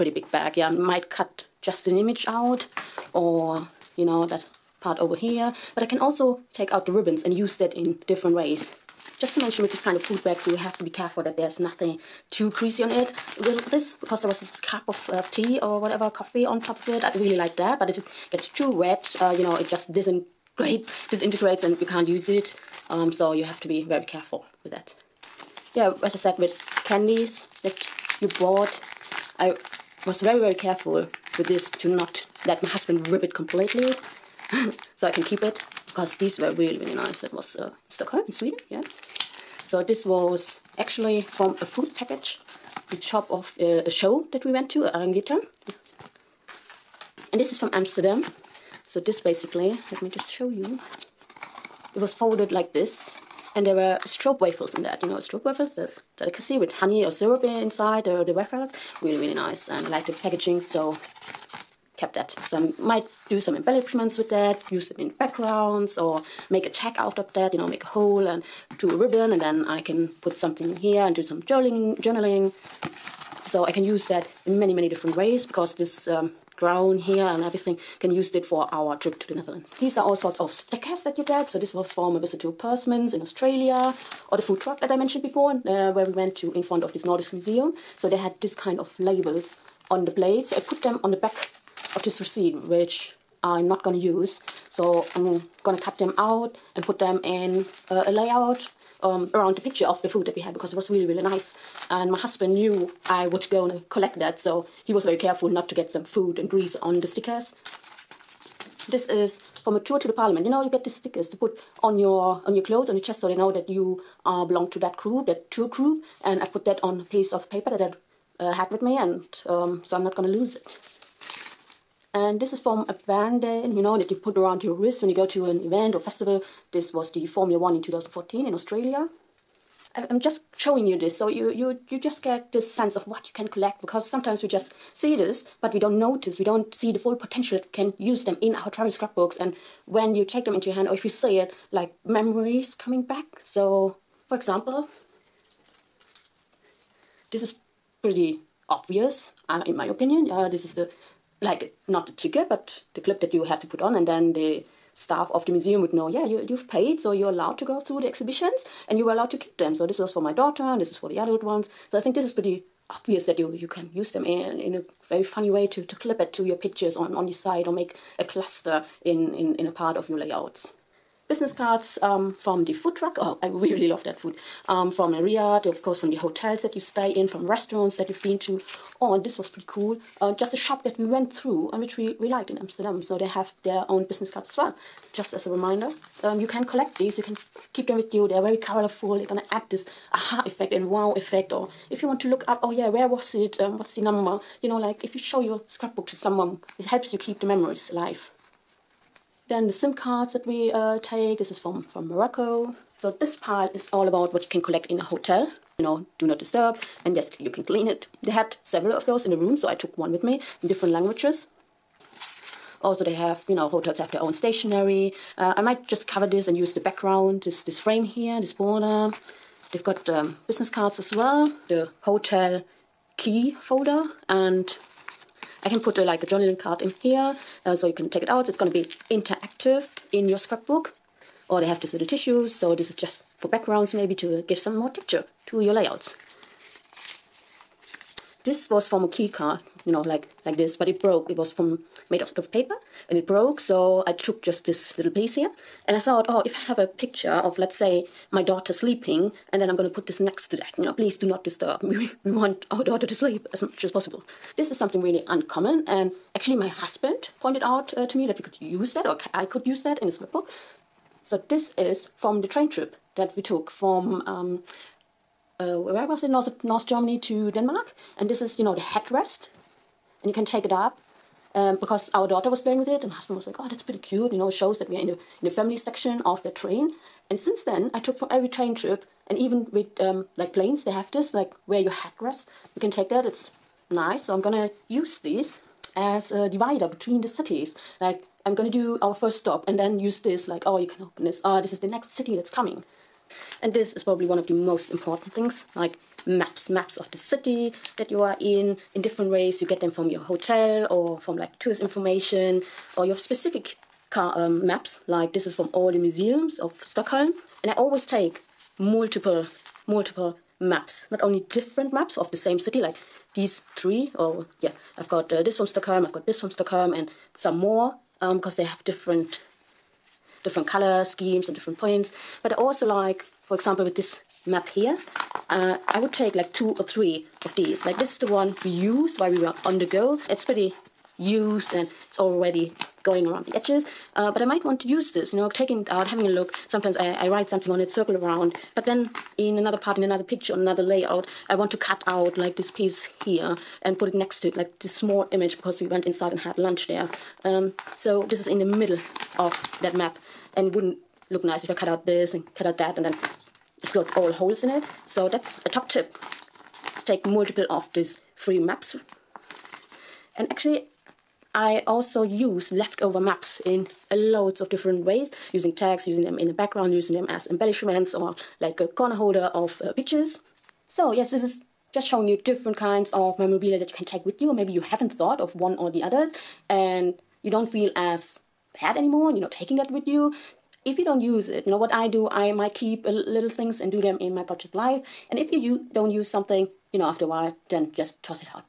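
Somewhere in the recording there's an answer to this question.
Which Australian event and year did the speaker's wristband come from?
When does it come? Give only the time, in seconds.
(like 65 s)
127 s.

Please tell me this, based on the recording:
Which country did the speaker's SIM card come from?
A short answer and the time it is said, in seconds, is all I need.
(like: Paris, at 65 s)
Morocco, at 202 s.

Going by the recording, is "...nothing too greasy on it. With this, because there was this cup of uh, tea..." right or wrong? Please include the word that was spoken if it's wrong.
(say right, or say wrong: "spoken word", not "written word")
right.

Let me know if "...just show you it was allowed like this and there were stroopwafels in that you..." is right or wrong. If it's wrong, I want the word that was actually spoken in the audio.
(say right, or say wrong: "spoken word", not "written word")
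wrong: "folded", not "allowed".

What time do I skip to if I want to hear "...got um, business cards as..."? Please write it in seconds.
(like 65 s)
219 s.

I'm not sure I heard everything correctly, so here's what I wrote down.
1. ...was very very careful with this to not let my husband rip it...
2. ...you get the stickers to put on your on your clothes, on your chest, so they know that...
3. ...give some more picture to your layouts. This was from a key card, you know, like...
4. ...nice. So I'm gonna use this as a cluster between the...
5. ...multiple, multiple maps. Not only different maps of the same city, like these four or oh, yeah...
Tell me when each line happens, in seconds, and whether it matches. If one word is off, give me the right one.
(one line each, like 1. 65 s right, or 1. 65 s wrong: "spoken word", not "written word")
1. 30 s right
2. 110 s right
3. 234 s wrong: "texture", not "picture"
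4. 283 s wrong: "divider", not "cluster"
5. 308 s wrong: "three", not "four".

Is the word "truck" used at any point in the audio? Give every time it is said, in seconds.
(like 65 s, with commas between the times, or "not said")
84 s, 172 s.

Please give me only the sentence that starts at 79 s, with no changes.
These are all sorts of stickers that you get.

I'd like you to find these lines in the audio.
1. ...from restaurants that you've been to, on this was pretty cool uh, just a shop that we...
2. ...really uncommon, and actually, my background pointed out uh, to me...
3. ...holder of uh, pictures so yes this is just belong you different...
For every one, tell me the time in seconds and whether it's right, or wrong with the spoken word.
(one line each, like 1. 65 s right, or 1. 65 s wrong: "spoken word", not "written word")
1. 177 s right
2. 255 s wrong: "husband", not "background"
3. 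369 s wrong: "showing", not "belong".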